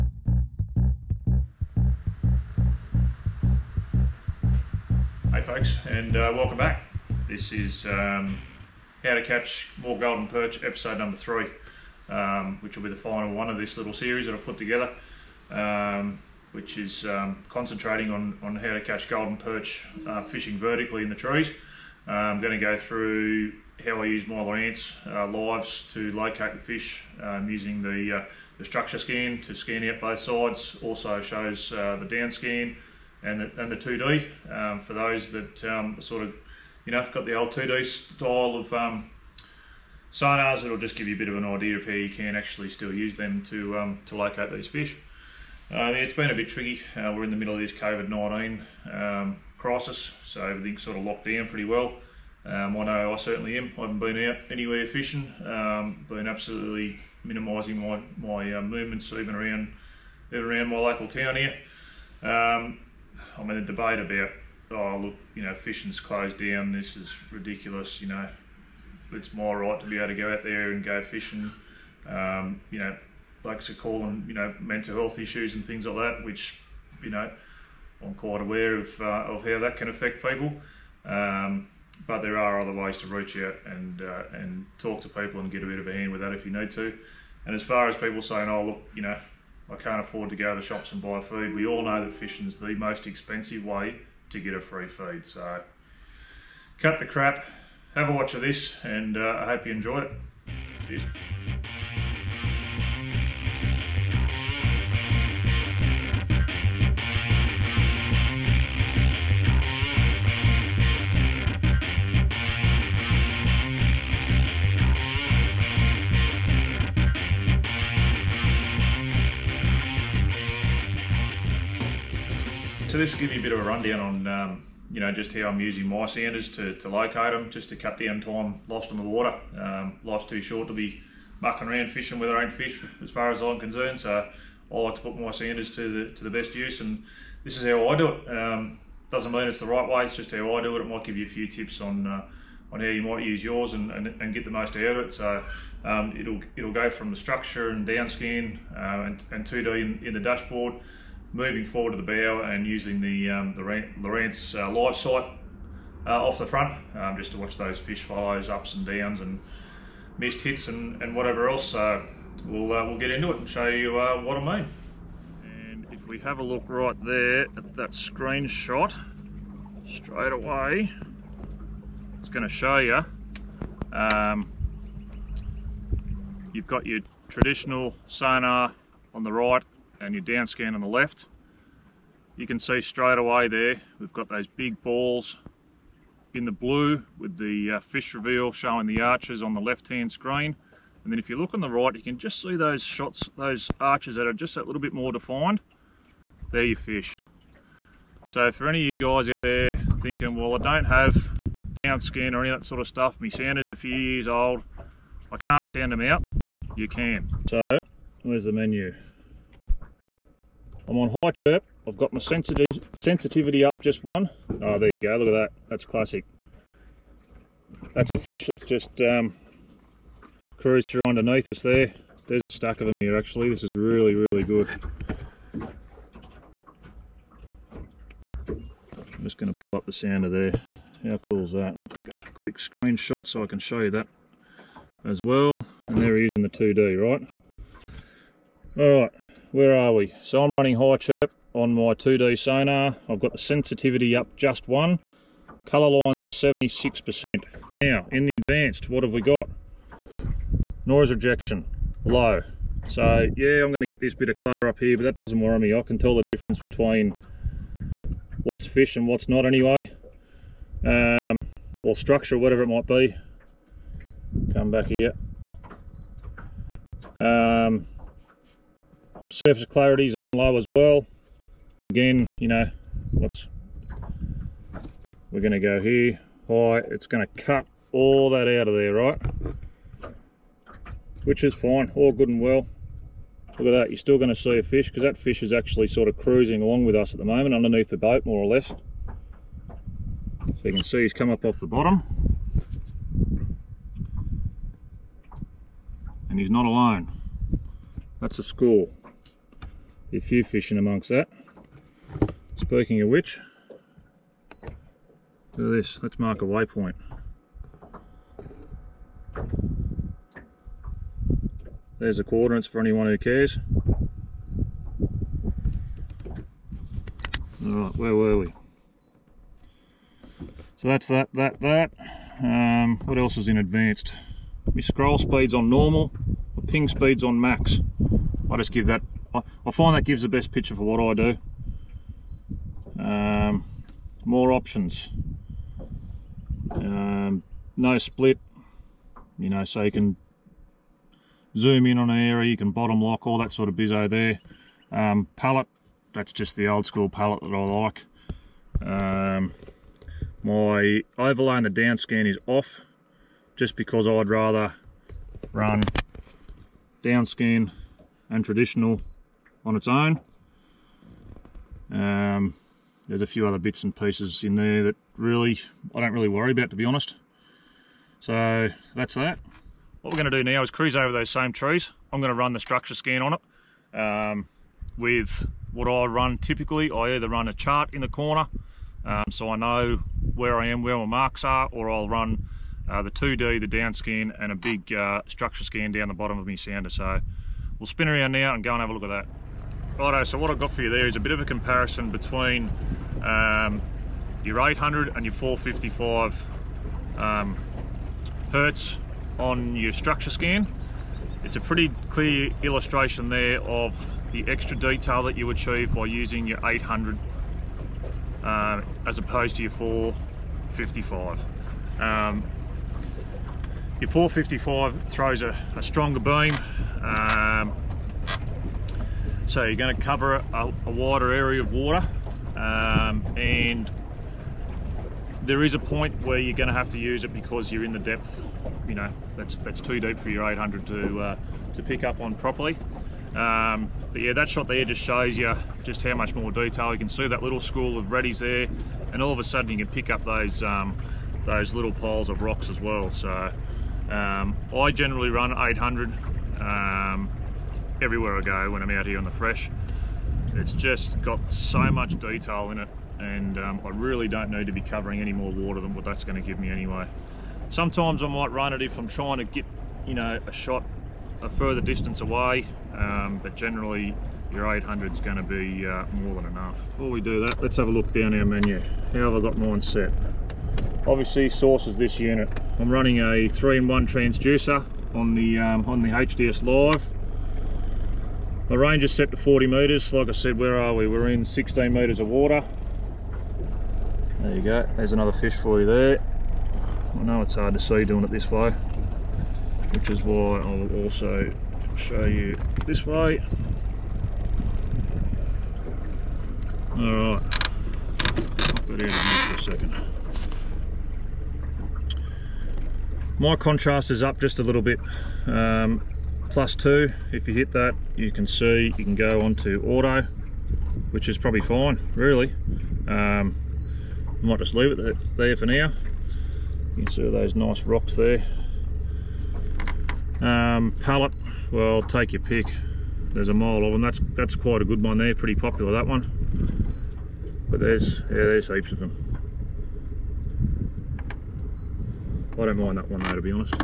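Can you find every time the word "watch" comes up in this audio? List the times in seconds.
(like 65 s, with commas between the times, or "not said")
98 s, 157 s.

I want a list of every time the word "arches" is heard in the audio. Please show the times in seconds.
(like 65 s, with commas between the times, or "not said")
189 s, 193 s.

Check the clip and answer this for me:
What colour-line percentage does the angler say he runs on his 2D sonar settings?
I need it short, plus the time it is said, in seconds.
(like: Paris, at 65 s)
76%, at 246 s.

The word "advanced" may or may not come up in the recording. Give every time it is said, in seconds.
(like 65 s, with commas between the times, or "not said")
248 s, 323 s.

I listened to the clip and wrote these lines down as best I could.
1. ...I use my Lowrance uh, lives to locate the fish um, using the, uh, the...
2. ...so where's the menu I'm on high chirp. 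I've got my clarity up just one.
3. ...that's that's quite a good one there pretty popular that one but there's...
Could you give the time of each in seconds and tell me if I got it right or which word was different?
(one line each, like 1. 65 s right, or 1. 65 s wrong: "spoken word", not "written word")
1. 24 s right
2. 207 s wrong: "sensitivity", not "clarity"
3. 524 s right.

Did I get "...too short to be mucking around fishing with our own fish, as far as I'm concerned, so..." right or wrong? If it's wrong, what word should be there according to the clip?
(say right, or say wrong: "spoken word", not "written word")
right.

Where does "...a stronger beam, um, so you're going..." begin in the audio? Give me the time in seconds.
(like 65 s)
415 s.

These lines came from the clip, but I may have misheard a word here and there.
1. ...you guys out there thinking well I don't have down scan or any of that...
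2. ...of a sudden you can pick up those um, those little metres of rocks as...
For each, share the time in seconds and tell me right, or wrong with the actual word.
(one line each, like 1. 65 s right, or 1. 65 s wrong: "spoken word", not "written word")
1. 198 s right
2. 439 s wrong: "piles", not "metres".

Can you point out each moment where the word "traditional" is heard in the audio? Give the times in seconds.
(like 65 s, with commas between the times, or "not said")
177 s, 358 s.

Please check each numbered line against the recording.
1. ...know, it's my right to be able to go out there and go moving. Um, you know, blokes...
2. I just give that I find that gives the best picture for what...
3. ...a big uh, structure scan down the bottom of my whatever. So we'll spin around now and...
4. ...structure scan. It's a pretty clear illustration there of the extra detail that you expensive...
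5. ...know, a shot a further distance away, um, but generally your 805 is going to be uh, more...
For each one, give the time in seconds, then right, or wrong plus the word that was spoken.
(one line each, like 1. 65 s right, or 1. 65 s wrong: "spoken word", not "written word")
1. 68 s wrong: "fishing", not "moving"
2. 328 s right
3. 384 s wrong: "sounder", not "whatever"
4. 399 s wrong: "achieve", not "expensive"
5. 460 s wrong: "800", not "805".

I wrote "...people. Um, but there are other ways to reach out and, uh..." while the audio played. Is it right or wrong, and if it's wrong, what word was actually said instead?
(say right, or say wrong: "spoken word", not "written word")
right.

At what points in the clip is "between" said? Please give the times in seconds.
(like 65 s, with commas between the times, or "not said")
256 s, 392 s.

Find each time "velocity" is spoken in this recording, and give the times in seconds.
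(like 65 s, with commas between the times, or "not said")
not said.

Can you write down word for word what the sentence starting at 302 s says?
Speaking of which, do this, let's mark a waypoint.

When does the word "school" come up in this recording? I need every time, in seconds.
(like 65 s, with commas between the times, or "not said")
298 s, 346 s, 437 s.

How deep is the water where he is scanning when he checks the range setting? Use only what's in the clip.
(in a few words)
16 metres.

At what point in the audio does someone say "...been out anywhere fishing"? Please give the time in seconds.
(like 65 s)
53 s.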